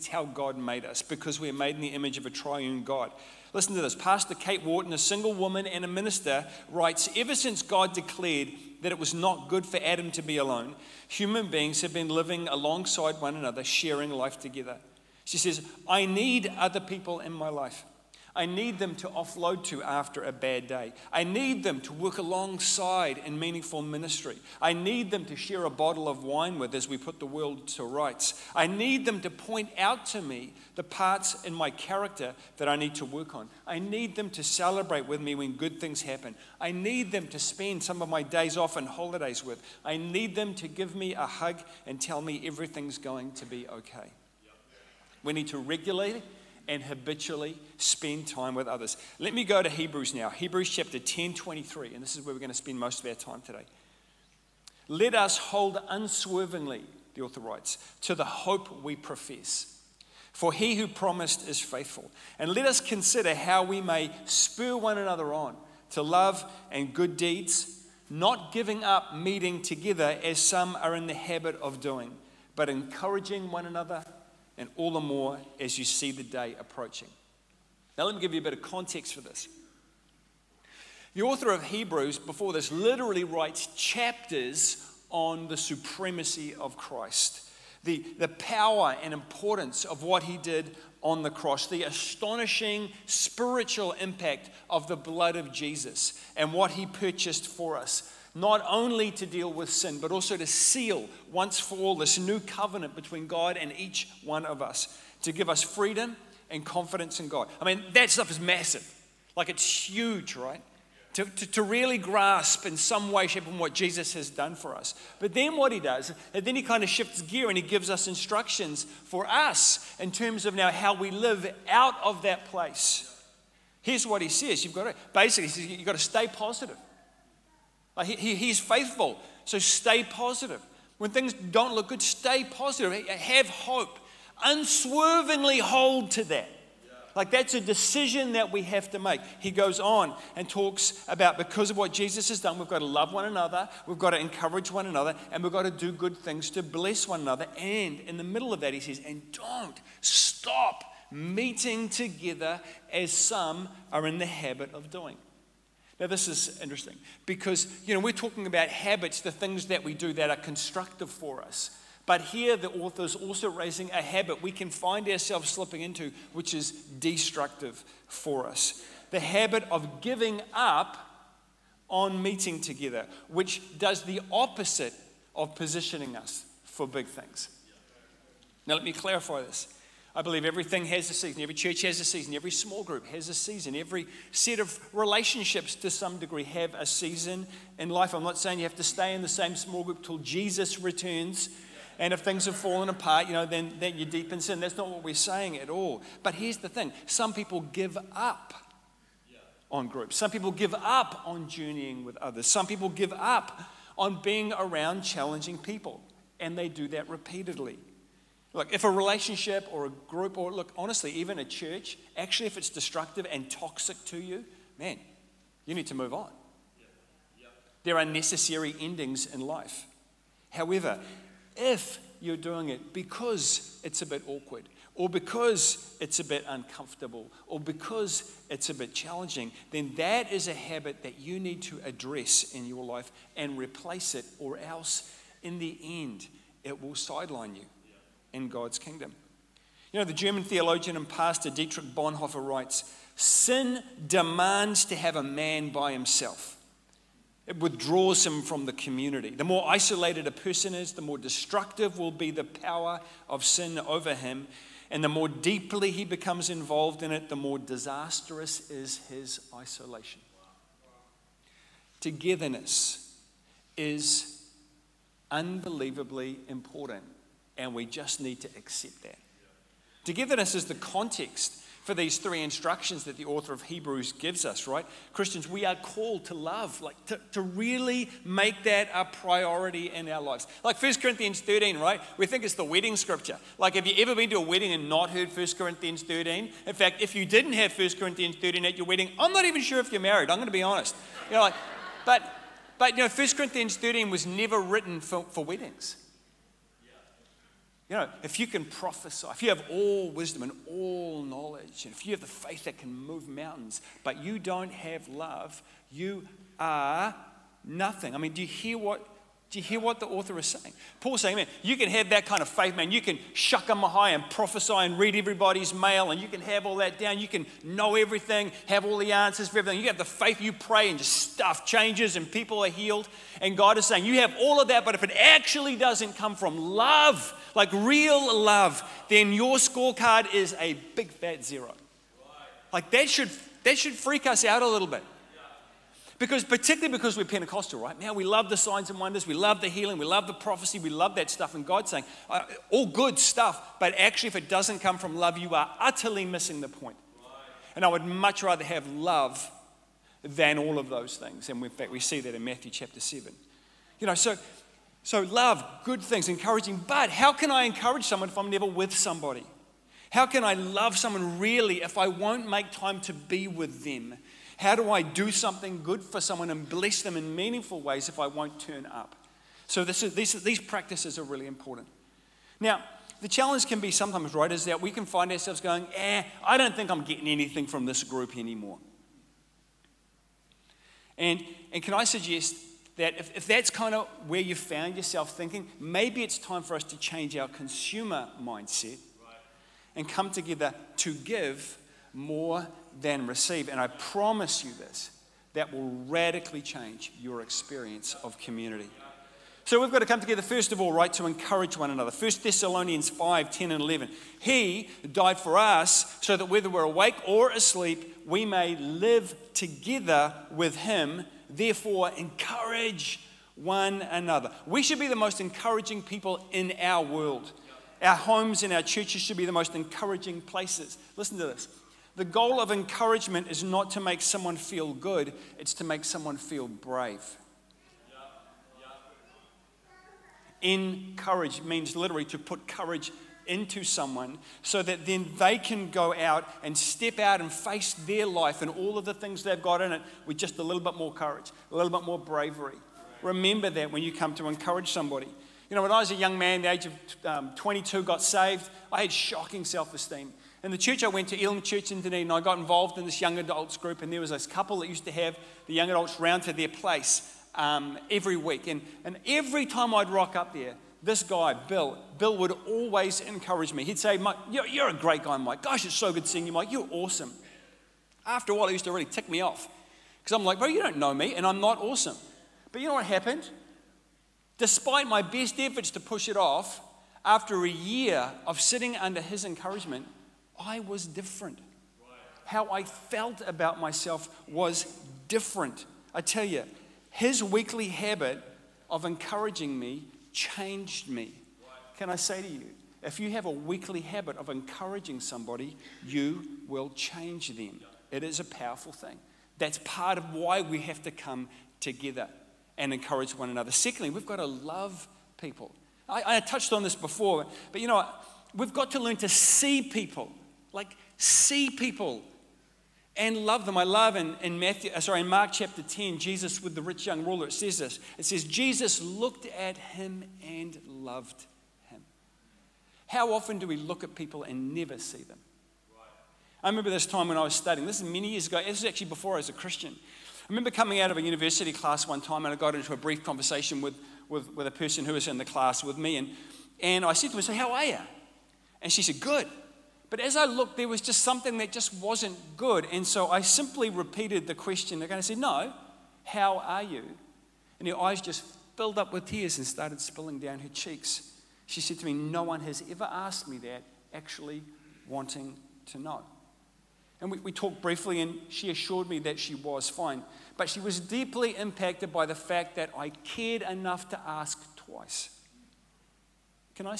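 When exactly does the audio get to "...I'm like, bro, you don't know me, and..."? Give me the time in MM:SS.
07:50.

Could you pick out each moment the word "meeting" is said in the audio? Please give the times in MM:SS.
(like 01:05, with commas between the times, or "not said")
01:09, 02:31, 02:52.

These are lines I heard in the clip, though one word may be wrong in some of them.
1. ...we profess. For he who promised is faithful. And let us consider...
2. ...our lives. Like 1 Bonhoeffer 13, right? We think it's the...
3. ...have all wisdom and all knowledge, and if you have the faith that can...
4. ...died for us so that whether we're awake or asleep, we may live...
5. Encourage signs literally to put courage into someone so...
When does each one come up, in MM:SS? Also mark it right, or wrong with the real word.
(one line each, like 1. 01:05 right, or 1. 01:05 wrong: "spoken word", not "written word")
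1. 00:58 right
2. 04:40 wrong: "Corinthians", not "Bonhoeffer"
3. 04:59 right
4. 06:45 right
5. 07:10 wrong: "means", not "signs".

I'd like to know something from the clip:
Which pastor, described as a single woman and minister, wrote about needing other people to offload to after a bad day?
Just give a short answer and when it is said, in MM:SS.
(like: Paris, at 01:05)
Kate Wharton, at 00:04.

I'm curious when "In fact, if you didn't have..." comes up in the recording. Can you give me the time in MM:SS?
04:46.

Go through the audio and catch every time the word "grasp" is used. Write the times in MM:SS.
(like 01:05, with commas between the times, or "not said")
01:51.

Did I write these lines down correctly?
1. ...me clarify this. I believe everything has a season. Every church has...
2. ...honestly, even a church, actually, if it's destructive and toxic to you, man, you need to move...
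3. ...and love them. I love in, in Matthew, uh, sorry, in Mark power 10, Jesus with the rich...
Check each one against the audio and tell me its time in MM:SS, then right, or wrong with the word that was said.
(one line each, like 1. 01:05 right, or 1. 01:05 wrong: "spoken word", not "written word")
1. 02:58 right
2. 03:30 right
3. 08:33 wrong: "chapter", not "power".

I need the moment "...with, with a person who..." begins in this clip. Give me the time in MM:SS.
08:54.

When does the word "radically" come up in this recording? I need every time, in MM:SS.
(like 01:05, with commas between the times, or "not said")
06:36.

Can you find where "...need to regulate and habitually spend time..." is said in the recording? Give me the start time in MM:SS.
00:45.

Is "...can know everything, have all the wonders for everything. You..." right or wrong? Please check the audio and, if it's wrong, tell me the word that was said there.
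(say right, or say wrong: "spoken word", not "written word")
wrong: "answers", not "wonders".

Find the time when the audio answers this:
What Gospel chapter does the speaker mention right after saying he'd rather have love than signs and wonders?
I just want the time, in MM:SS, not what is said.
05:52.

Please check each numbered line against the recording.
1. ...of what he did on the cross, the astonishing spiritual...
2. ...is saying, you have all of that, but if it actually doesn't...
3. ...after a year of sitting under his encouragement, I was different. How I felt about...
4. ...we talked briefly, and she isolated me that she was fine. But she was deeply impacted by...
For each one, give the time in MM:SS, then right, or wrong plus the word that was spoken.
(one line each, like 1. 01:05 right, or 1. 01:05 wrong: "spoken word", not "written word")
1. 01:29 right
2. 05:23 right
3. 07:57 right
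4. 09:17 wrong: "assured", not "isolated".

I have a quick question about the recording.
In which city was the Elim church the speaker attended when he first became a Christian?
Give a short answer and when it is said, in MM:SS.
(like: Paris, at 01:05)
Dunedin, at 07:32.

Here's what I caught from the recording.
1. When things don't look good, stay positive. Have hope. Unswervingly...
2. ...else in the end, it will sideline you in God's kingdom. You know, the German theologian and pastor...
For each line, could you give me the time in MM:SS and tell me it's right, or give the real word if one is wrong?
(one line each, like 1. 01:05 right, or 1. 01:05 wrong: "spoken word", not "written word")
1. 02:10 right
2. 03:54 right.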